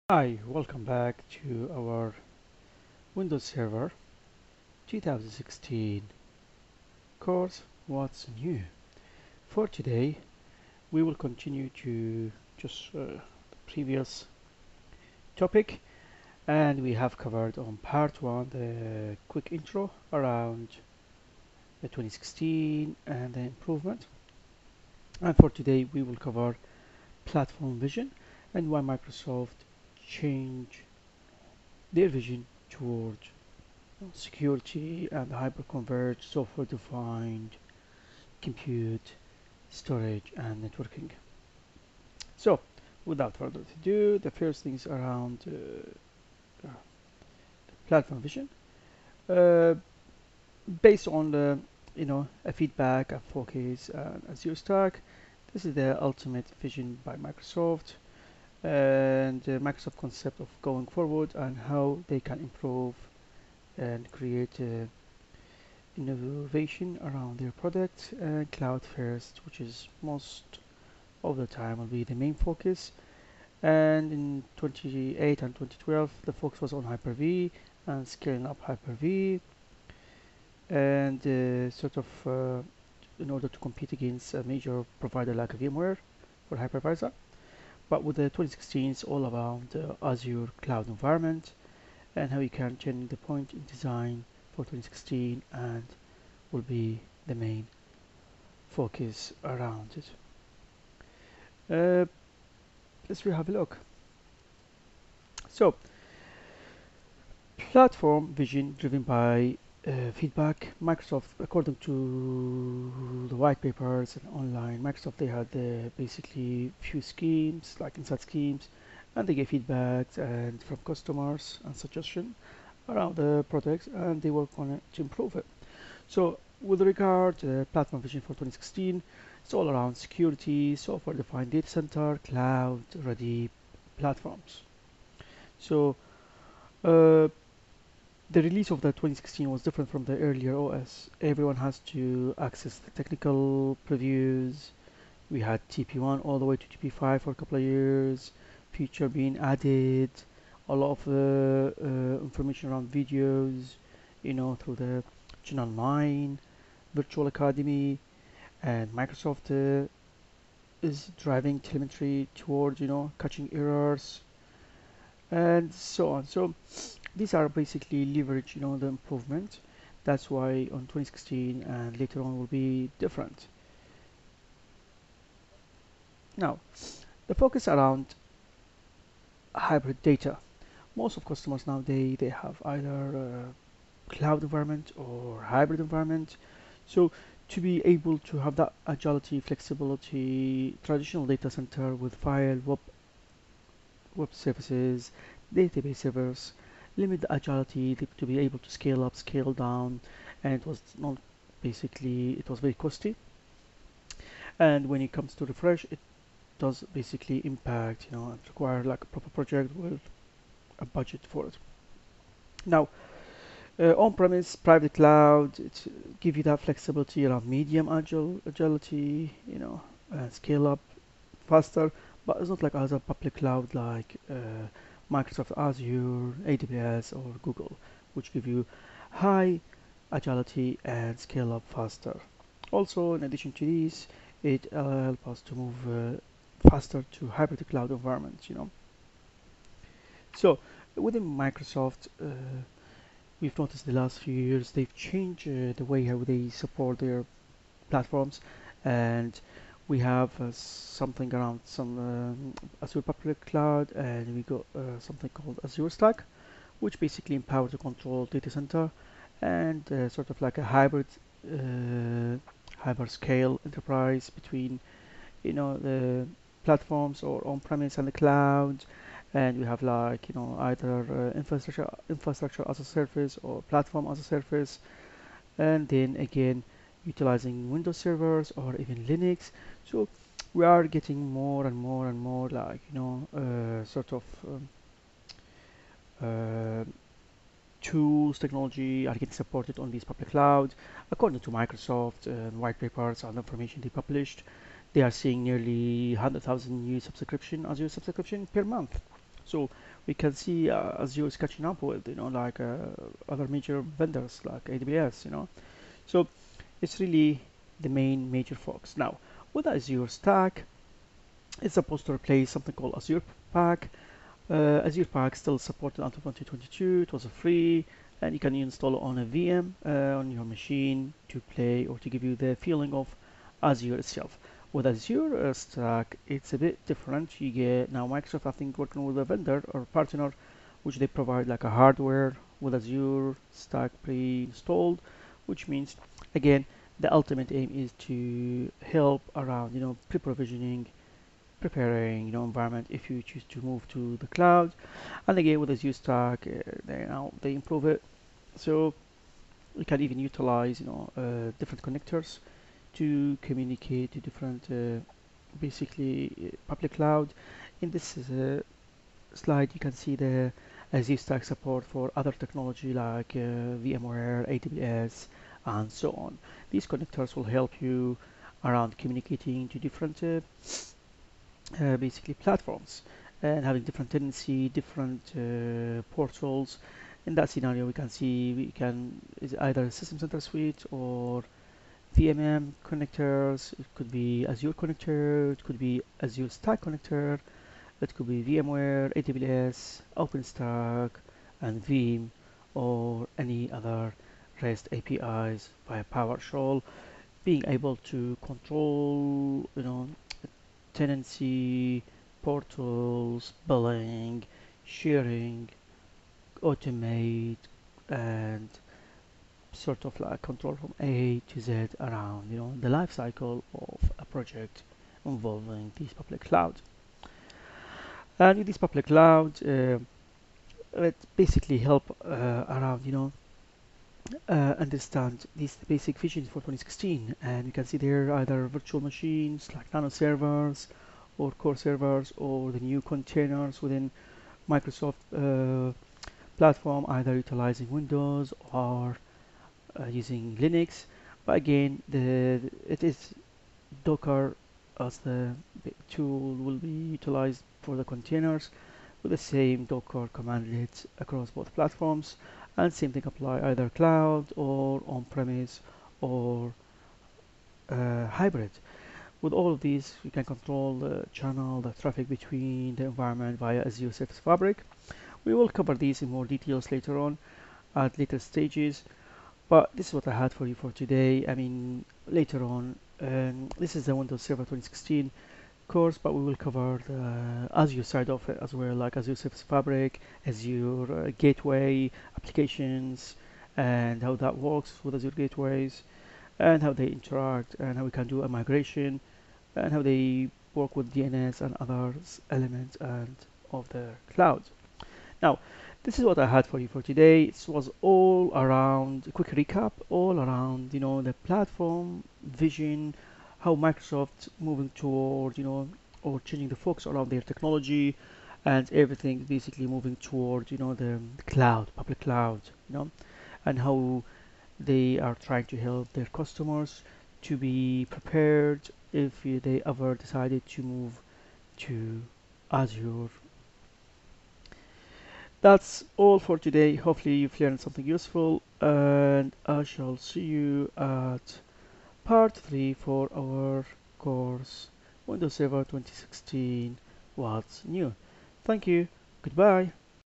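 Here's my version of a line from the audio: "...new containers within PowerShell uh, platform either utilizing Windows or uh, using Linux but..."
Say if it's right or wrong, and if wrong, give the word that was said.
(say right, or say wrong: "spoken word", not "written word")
wrong: "Microsoft", not "PowerShell".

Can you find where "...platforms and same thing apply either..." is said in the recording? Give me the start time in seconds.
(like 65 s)
451 s.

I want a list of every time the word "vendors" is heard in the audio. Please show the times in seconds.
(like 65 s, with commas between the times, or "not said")
303 s, 329 s.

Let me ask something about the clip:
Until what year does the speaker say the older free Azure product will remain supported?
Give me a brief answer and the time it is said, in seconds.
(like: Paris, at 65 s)
2022, at 316 s.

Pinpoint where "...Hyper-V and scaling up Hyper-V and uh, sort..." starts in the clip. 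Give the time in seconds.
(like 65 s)
76 s.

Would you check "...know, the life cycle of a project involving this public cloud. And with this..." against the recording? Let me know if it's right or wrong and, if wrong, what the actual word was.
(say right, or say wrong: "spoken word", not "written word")
right.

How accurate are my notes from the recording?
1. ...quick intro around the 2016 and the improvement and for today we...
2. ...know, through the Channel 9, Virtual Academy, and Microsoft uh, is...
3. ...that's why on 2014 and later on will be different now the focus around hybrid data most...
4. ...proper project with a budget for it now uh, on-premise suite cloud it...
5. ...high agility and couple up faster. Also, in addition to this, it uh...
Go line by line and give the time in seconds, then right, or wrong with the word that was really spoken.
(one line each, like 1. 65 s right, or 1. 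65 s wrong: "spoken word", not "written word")
1. 19 s right
2. 154 s right
3. 170 s wrong: "2016", not "2014"
4. 209 s wrong: "private", not "suite"
5. 229 s wrong: "scale", not "couple".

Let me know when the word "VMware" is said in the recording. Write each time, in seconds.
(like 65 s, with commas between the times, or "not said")
85 s, 363 s, 388 s.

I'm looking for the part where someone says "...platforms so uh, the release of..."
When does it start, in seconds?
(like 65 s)
133 s.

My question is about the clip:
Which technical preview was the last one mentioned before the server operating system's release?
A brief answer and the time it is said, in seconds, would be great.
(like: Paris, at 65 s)
TP5, at 146 s.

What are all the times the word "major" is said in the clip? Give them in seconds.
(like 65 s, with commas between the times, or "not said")
84 s, 303 s, 308 s.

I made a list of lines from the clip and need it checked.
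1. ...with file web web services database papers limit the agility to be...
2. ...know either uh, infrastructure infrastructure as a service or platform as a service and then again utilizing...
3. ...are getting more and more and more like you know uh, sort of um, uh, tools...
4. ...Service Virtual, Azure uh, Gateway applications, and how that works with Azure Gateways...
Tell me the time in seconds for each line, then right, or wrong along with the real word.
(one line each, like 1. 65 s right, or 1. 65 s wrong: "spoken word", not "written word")
1. 191 s wrong: "servers", not "papers"
2. 270 s right
3. 280 s right
4. 479 s wrong: "Fabric", not "Virtual".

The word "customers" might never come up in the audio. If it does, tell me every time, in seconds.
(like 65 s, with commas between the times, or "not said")
120 s, 181 s, 516 s.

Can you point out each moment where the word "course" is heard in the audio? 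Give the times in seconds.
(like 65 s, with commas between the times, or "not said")
7 s, 475 s, 534 s.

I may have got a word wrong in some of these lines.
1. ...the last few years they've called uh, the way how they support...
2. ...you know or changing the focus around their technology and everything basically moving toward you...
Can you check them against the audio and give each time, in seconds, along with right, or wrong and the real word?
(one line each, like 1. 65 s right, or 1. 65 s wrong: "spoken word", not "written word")
1. 243 s wrong: "changed", not "called"
2. 505 s right.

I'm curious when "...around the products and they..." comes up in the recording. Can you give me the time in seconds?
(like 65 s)
122 s.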